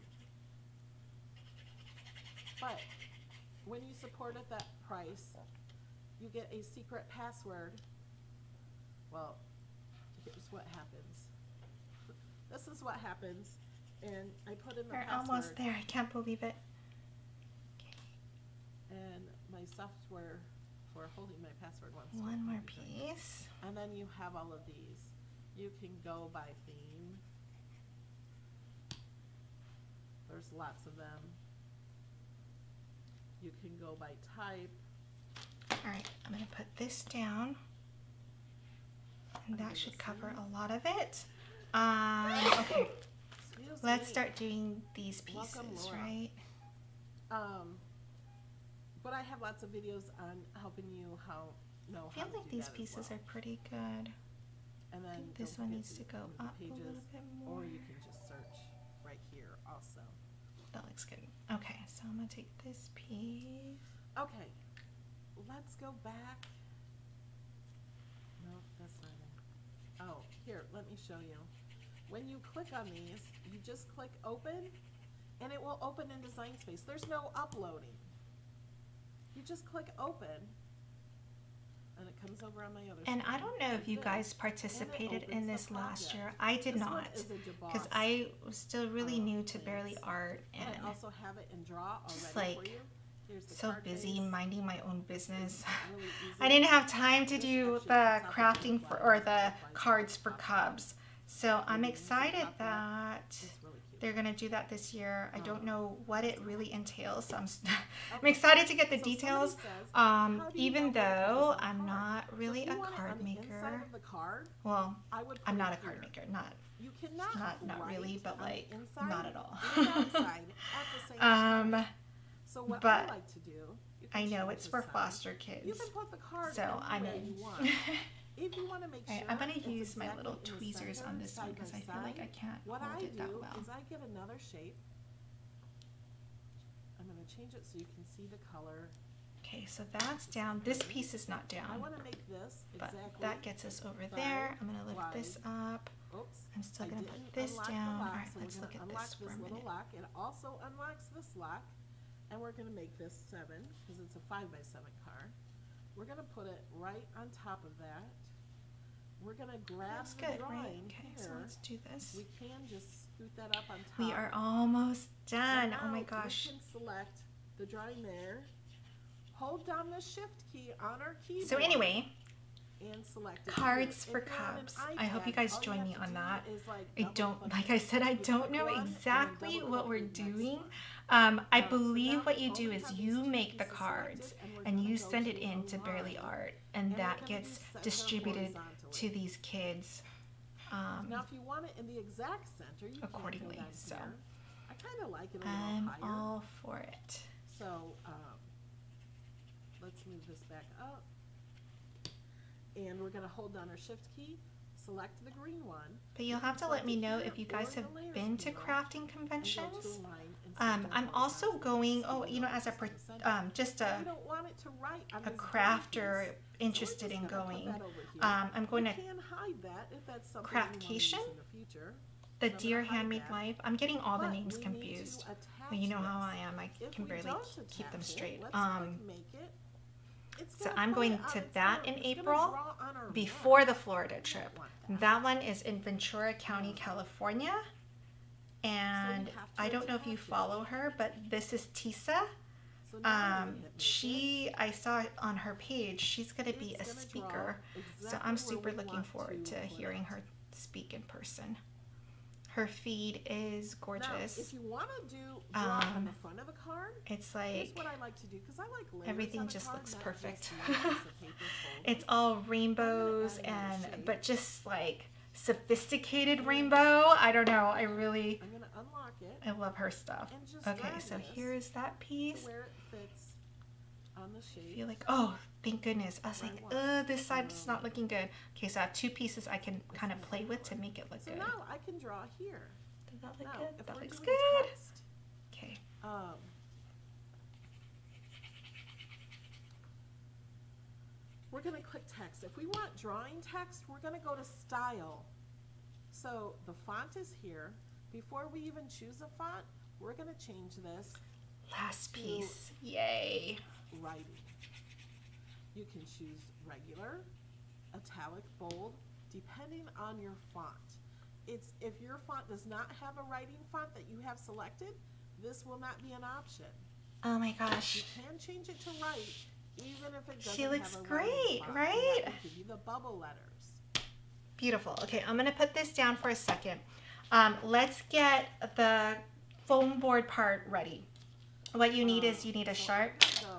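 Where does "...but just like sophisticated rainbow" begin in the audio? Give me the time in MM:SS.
04:24.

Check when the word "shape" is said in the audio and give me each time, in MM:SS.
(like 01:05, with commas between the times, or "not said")
02:14, 04:34.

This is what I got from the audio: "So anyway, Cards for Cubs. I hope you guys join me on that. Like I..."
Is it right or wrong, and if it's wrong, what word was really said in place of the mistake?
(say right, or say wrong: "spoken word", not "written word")
right.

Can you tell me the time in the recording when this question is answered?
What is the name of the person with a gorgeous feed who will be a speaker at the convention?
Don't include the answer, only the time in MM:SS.
04:01.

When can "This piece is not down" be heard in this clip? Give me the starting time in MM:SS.
02:20.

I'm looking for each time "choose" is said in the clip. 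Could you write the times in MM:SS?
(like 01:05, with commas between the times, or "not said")
04:58, 05:06.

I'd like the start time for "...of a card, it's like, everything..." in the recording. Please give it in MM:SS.
04:16.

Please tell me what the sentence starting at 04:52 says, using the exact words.
If we want drawing text, we're going to go to style.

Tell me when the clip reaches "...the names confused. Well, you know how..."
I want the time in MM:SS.
03:44.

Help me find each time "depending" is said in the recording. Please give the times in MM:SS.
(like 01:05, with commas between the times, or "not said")
05:09.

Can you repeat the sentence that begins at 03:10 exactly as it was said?
Um, now, if you want it in the exact center, you accordingly.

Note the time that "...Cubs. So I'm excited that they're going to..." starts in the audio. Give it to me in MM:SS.
01:40.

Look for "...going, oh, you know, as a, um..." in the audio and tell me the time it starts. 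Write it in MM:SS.
03:31.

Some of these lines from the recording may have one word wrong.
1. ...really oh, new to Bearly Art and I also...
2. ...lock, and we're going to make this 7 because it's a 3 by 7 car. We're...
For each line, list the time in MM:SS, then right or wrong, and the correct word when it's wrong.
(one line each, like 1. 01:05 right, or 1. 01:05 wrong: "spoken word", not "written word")
1. 01:28 right
2. 02:31 wrong: "5", not "3".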